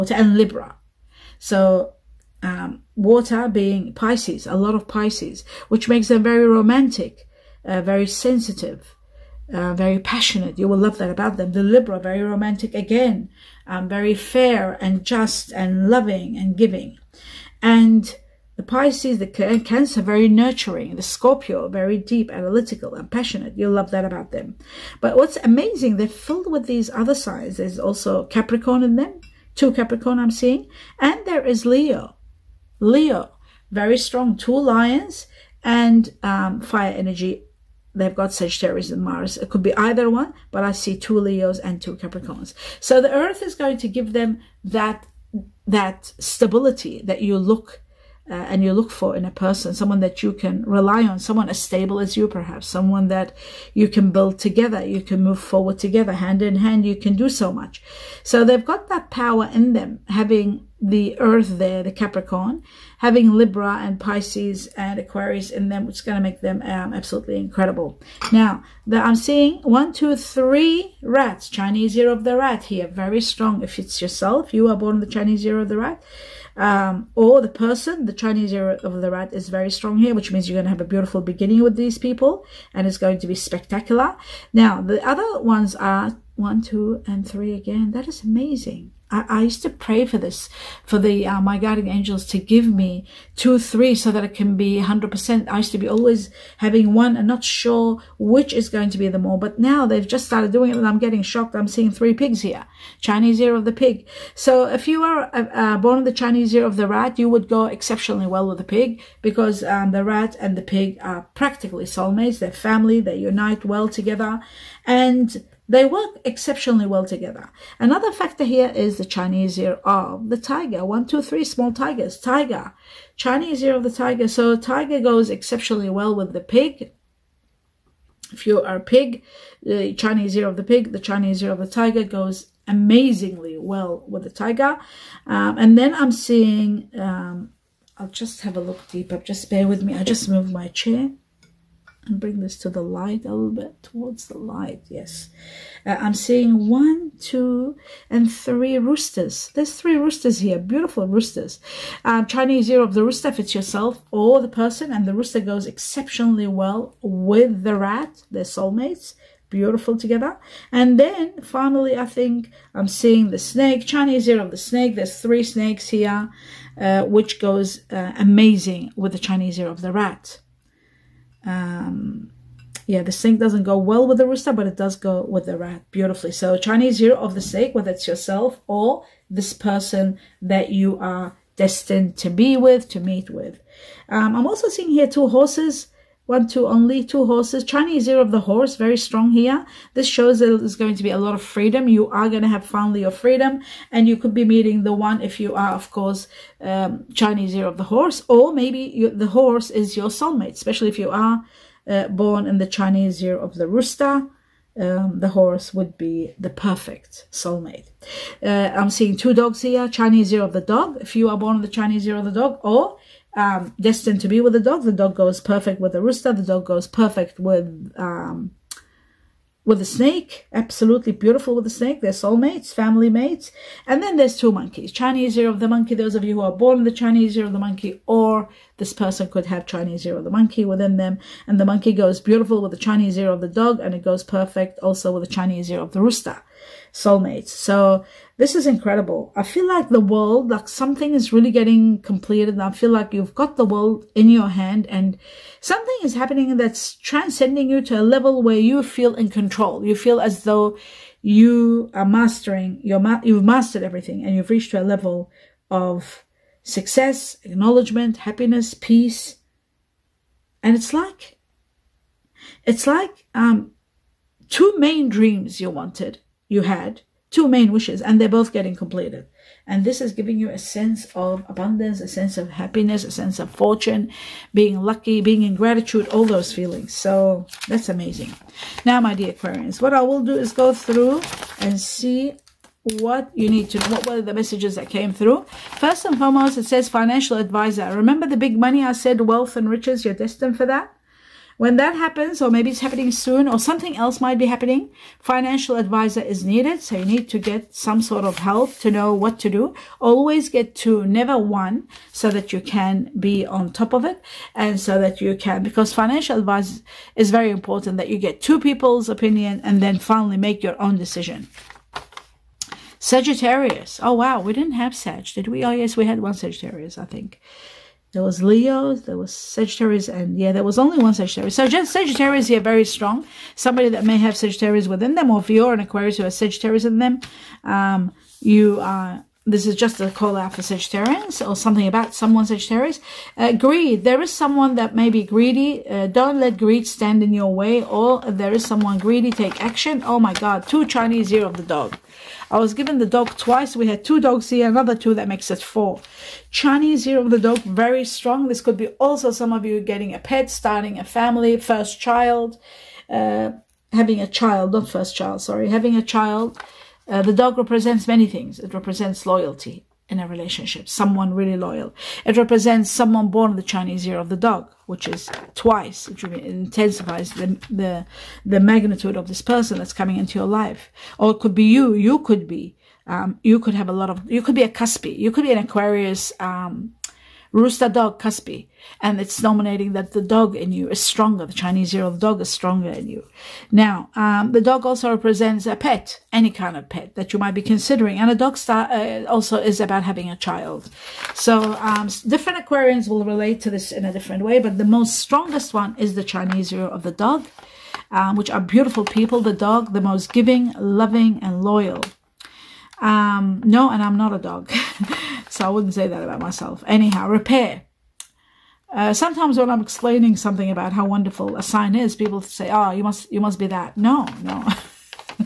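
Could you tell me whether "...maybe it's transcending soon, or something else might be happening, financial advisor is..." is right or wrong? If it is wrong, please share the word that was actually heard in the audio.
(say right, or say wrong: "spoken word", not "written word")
wrong: "happening", not "transcending".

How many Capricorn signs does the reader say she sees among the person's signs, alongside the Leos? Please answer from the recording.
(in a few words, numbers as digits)
2.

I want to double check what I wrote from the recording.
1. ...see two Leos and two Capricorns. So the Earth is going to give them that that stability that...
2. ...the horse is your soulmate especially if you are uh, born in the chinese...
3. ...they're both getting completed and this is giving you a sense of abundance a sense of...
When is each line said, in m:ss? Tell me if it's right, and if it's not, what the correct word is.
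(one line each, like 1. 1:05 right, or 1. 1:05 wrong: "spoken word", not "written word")
1. 0:40 right
2. 3:19 right
3. 4:28 right.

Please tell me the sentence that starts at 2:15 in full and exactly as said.
Um, and then I'm seeing, um, I'll just have a look deeper.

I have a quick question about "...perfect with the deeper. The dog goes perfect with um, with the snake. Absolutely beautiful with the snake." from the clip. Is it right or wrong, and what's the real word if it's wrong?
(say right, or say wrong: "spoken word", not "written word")
wrong: "rooster", not "deeper".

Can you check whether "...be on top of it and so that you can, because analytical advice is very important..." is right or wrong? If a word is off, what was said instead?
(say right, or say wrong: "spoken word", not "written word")
wrong: "financial", not "analytical".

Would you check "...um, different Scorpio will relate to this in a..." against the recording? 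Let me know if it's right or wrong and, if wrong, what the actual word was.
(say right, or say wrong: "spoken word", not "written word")
wrong: "Aquarians", not "Scorpio".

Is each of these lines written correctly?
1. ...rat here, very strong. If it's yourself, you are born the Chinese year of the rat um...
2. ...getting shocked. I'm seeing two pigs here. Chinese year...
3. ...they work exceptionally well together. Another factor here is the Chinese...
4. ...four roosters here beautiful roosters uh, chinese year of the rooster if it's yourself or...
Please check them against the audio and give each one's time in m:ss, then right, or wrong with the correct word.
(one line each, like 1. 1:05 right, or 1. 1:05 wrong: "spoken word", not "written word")
1. 1:12 right
2. 1:40 wrong: "three", not "two"
3. 1:55 right
4. 2:29 wrong: "three", not "four".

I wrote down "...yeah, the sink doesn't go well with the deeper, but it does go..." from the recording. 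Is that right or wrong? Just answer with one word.
wrong.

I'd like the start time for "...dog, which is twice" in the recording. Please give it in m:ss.
6:04.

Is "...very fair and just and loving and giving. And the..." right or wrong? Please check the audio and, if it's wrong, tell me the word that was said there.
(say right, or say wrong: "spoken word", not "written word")
right.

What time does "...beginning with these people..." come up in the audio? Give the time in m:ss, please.
1:21.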